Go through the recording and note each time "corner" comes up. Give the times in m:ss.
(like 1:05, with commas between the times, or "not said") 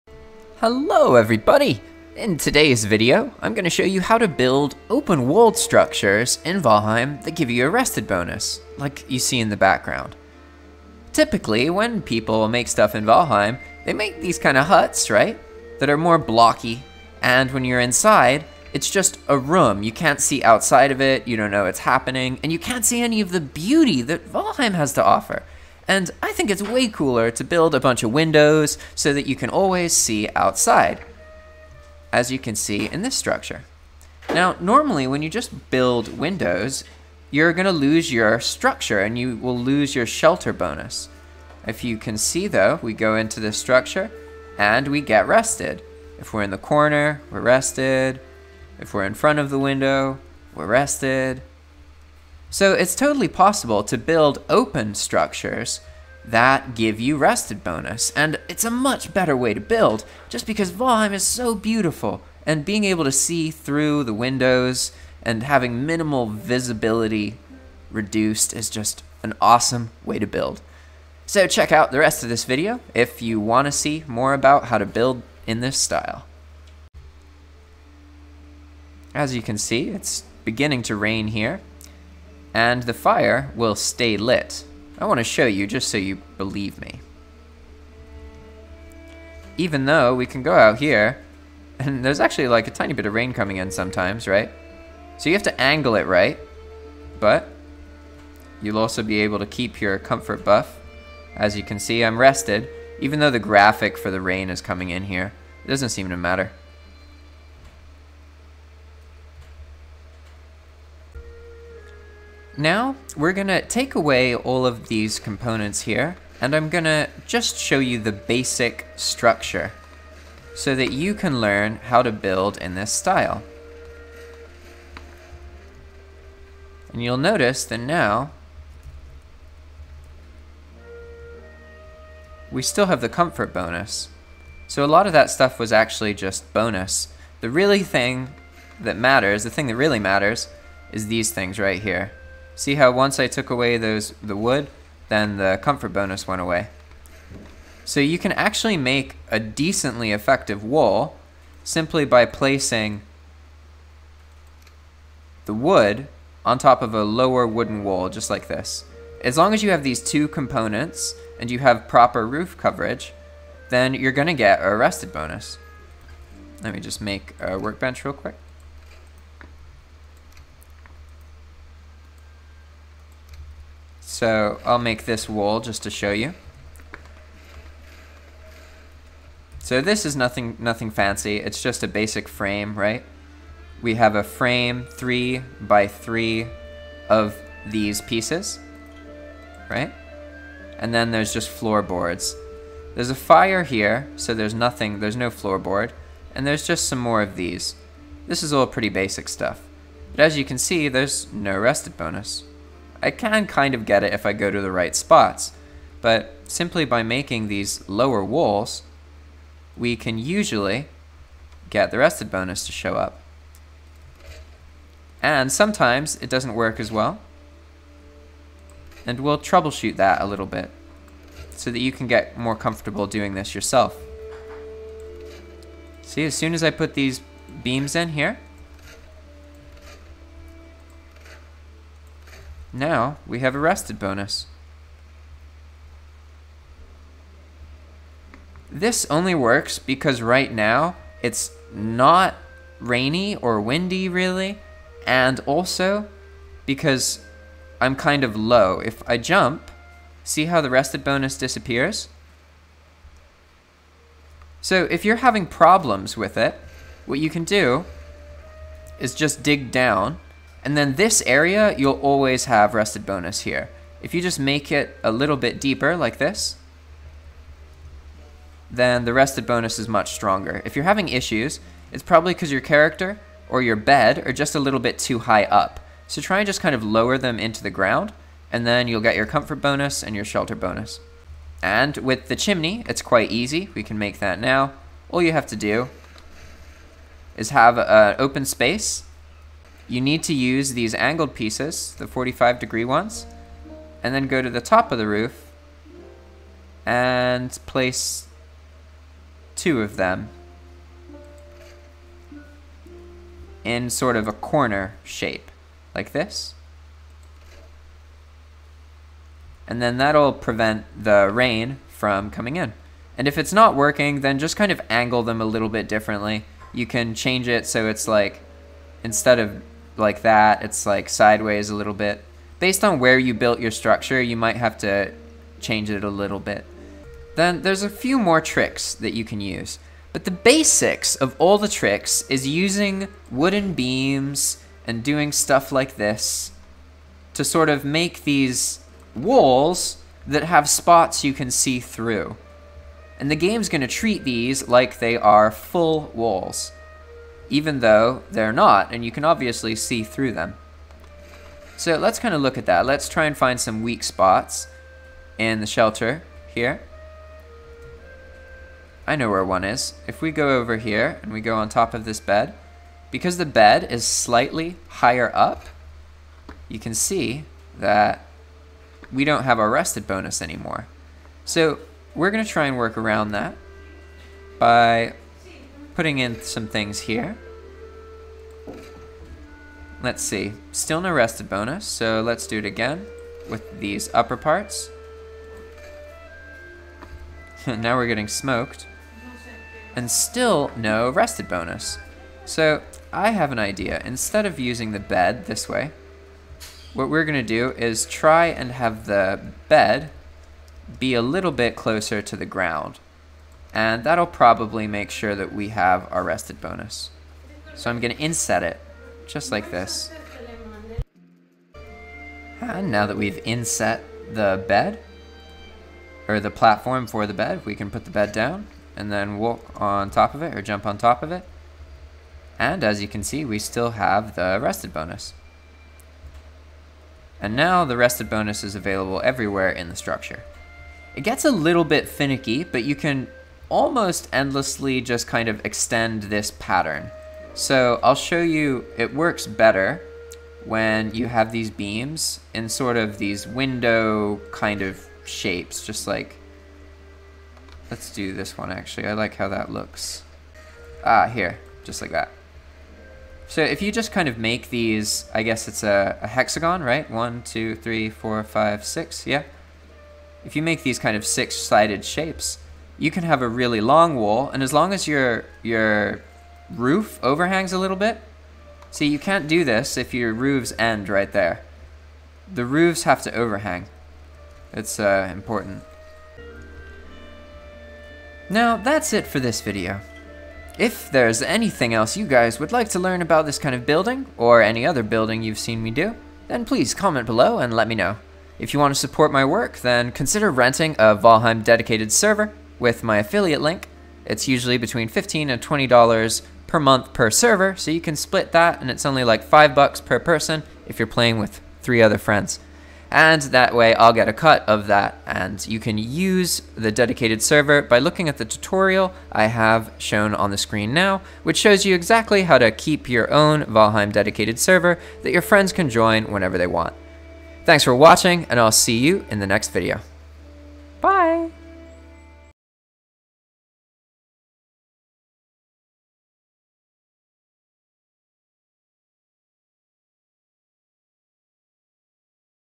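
0:46, 5:04.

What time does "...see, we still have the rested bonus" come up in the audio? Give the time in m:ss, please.
7:03.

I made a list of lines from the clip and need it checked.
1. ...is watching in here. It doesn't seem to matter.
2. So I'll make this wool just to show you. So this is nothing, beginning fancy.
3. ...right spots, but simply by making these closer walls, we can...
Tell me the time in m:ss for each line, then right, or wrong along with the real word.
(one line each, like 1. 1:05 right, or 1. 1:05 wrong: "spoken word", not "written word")
1. 1:44 wrong: "coming", not "watching"
2. 2:54 wrong: "nothing", not "beginning"
3. 3:24 wrong: "lower", not "closer".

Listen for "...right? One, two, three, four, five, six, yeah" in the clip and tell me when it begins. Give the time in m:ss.
7:36.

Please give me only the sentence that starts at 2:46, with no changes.
Let me just make a workbench real quick.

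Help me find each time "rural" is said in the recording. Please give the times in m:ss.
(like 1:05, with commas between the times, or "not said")
not said.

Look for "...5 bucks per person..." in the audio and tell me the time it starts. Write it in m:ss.
8:19.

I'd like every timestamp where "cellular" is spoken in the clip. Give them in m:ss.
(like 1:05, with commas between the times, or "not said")
not said.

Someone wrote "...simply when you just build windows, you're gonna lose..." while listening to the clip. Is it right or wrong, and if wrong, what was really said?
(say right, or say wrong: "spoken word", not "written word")
wrong: "normally", not "simply".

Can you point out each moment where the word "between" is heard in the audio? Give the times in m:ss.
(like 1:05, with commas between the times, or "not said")
8:14.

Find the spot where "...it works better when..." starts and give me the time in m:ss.
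7:18.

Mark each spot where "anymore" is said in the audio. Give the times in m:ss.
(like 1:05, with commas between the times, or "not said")
6:10.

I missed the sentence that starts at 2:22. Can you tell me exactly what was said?
See how once I took away those the wood, then the comfort bonus went away.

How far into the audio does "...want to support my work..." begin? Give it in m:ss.
8:08.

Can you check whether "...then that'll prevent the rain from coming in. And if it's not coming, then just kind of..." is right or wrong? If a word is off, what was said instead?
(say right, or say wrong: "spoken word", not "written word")
wrong: "working", not "coming".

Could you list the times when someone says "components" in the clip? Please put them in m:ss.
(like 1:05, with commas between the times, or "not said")
1:55, 2:40.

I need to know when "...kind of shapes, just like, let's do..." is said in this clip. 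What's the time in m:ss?
7:24.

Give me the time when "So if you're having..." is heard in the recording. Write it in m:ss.
4:14.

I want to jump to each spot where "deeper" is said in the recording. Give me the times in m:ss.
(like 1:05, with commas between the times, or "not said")
4:25.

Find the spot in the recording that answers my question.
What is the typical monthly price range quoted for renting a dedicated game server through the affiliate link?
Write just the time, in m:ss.
8:15.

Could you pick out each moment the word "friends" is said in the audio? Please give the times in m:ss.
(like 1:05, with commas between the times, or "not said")
8:22, 8:35.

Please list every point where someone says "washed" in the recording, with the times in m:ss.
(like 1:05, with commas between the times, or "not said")
not said.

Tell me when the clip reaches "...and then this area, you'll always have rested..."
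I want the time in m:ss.
4:20.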